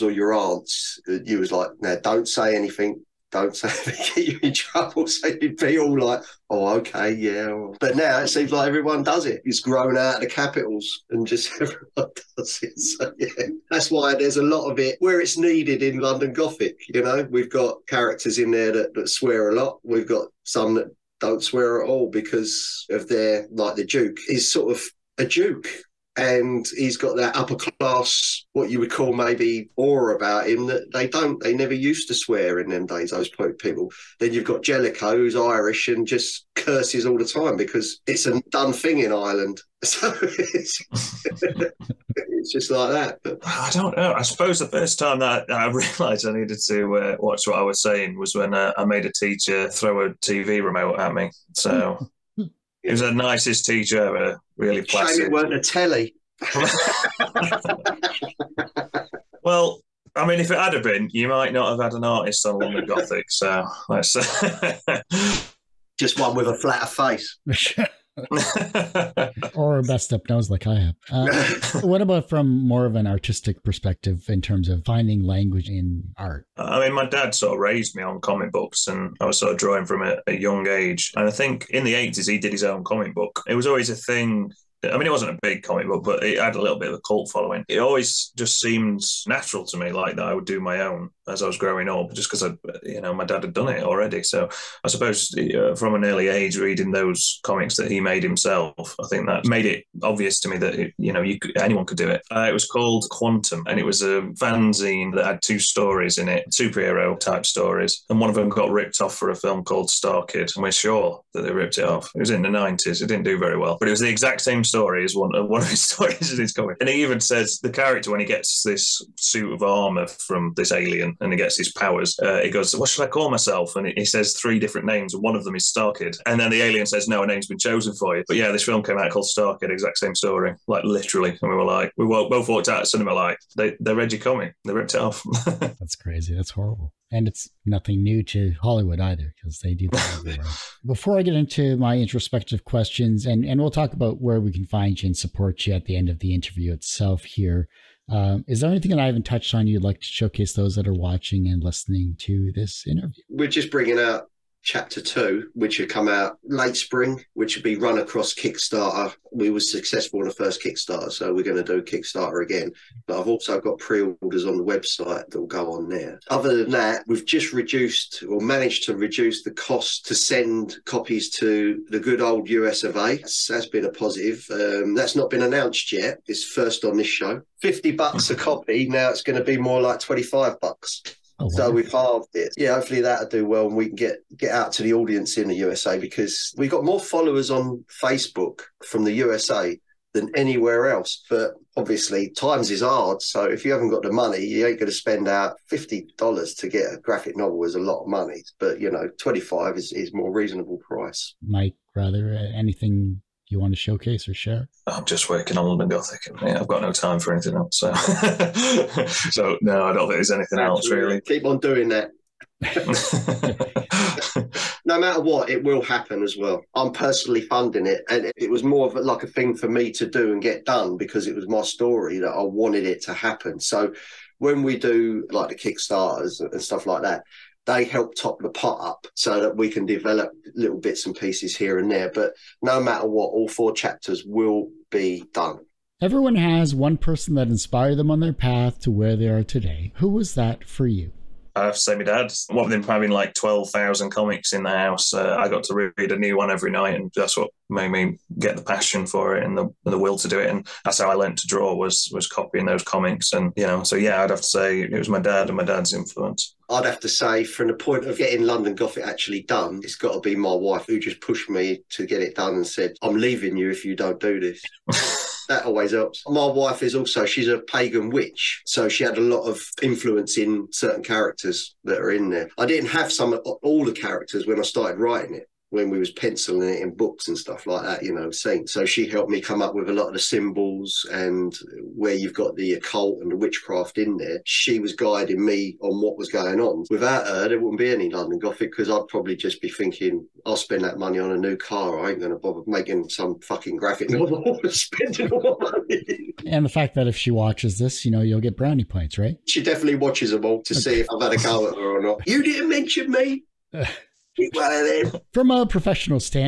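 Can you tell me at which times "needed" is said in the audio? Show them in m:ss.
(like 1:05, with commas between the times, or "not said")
0:15, 0:46.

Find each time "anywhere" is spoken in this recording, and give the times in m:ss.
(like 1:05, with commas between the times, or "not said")
3:10.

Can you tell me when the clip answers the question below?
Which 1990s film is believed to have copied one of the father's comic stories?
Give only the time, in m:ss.
1:49.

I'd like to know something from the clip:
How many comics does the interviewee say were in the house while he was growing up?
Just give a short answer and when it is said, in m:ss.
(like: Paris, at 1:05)
12,000, at 4:03.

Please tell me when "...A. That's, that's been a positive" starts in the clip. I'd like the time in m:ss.
2:52.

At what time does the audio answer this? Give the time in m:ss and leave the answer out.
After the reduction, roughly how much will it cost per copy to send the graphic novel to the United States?
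2:59.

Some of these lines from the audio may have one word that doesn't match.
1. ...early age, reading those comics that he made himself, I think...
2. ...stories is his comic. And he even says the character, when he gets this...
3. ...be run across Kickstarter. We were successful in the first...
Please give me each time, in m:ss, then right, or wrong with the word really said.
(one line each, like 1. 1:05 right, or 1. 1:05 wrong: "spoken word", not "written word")
1. 1:36 right
2. 1:55 right
3. 2:37 right.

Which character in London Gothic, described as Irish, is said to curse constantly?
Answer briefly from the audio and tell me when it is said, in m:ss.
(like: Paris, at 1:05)
Jellicoe, at 0:34.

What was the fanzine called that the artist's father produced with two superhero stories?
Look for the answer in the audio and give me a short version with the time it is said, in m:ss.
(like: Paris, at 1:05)
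Quantum, at 1:43.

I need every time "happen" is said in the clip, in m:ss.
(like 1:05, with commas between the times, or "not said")
3:35, 3:43.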